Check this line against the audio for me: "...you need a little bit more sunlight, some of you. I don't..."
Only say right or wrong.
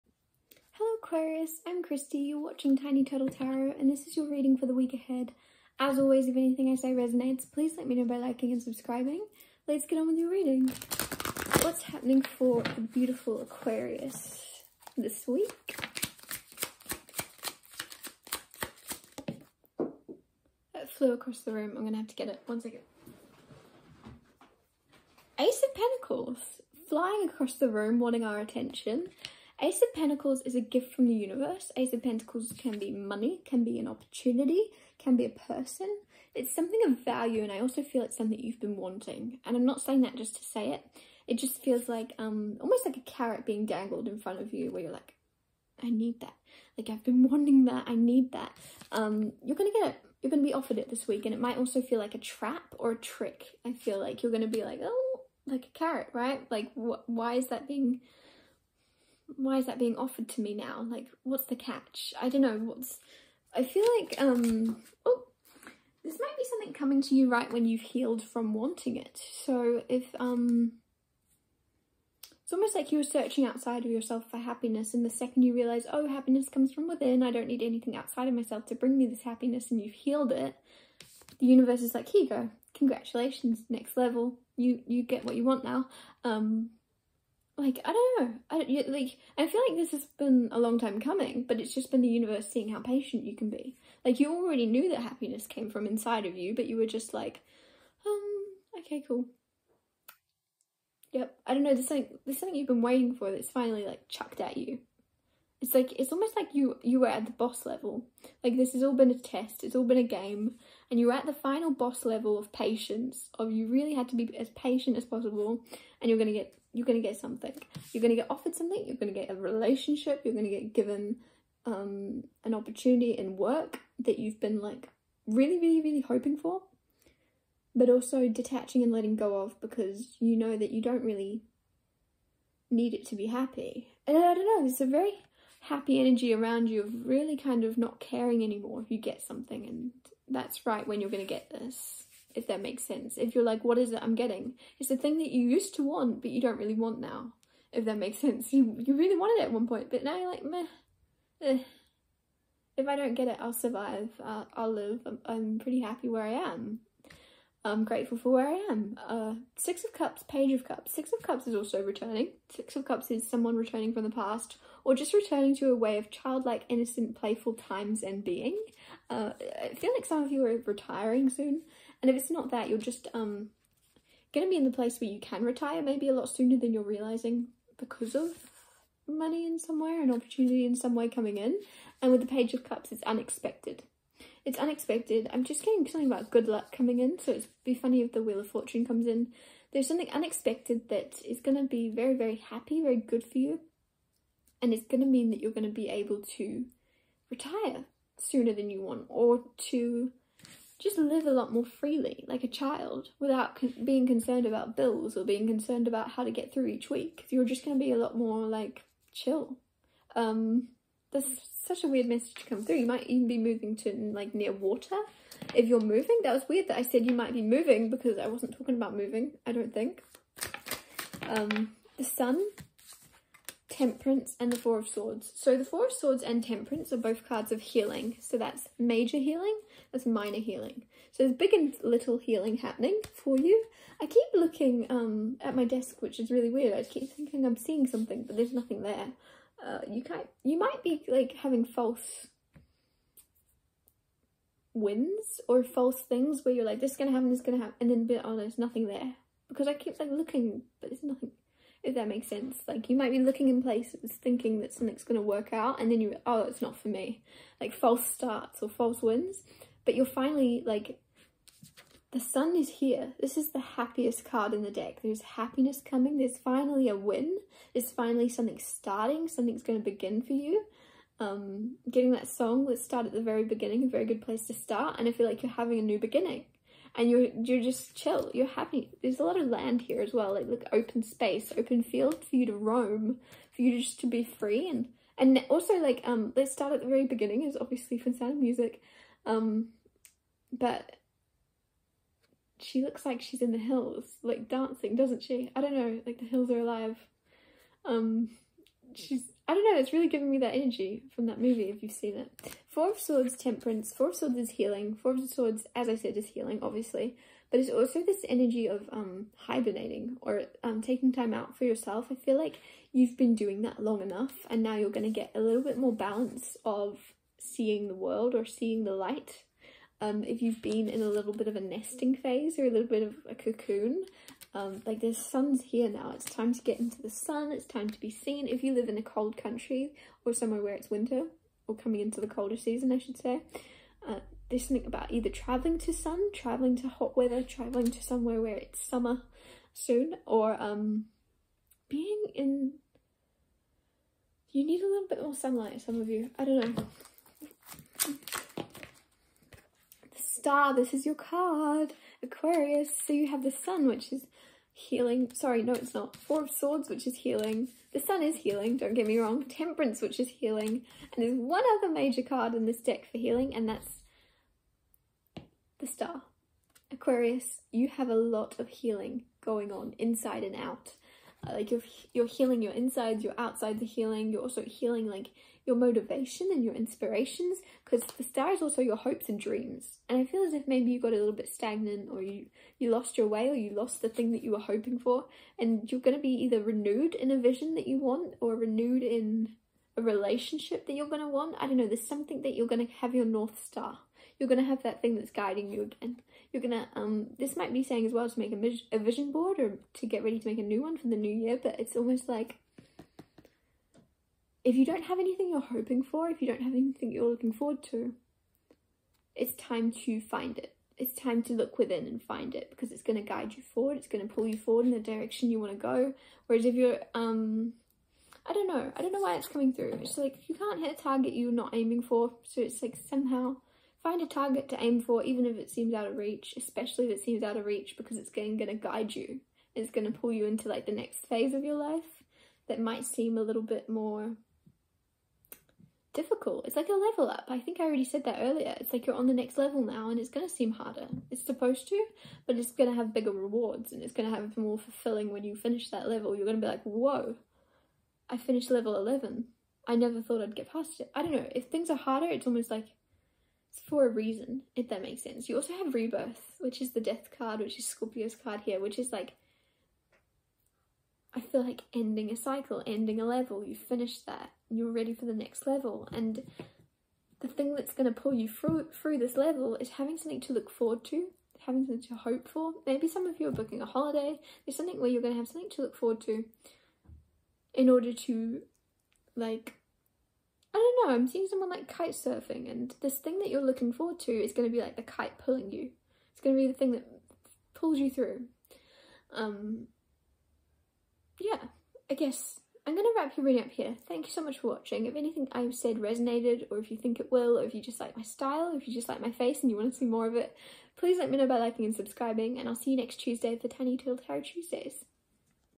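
right.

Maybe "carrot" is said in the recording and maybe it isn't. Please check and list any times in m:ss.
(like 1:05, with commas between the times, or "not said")
0:43, 0:55.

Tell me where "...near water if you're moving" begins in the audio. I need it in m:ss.
3:34.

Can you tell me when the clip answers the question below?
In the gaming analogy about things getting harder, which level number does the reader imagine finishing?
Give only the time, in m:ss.
7:28.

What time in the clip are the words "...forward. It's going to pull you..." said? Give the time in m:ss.
6:53.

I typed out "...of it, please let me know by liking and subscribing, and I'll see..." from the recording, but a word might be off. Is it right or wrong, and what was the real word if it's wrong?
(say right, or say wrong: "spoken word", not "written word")
right.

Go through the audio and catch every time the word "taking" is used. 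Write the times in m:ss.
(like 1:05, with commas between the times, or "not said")
5:10.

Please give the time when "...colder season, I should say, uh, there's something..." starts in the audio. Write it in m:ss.
5:32.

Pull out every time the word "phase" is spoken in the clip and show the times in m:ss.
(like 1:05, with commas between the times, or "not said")
5:22, 7:11.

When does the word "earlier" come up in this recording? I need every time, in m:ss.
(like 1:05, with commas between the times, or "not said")
7:18.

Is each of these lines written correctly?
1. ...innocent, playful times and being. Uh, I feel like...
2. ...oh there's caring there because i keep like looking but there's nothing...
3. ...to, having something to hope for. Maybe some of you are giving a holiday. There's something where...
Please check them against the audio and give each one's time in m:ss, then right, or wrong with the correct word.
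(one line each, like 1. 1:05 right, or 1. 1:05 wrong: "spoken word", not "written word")
1. 2:46 right
2. 4:08 wrong: "nothing", not "caring"
3. 7:51 wrong: "booking", not "giving".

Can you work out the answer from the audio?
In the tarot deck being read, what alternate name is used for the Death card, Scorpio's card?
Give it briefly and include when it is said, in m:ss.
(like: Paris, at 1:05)
Rebirth, at 7:35.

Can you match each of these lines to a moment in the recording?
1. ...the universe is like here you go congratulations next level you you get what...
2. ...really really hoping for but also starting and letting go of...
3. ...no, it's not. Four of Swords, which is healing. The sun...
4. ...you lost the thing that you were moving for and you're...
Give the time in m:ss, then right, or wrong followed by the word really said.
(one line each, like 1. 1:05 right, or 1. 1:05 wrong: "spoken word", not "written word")
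1. 1:21 right
2. 2:05 wrong: "detaching", not "starting"
3. 5:55 right
4. 6:23 wrong: "hoping", not "moving".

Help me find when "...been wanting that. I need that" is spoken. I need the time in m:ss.
0:47.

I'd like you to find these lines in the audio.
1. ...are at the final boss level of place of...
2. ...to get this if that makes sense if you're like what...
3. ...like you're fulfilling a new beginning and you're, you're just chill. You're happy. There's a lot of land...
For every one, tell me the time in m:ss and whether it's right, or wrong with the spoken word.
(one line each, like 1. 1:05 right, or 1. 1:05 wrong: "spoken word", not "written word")
1. 1:51 wrong: "patience", not "place"
2. 2:21 right
3. 4:35 wrong: "having", not "fulfilling".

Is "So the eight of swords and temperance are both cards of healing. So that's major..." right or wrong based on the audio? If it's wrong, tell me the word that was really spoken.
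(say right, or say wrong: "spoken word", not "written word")
wrong: "four", not "eight".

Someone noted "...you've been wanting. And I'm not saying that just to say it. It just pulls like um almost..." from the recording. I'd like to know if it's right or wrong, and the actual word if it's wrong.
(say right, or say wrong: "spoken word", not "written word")
wrong: "feels", not "pulls".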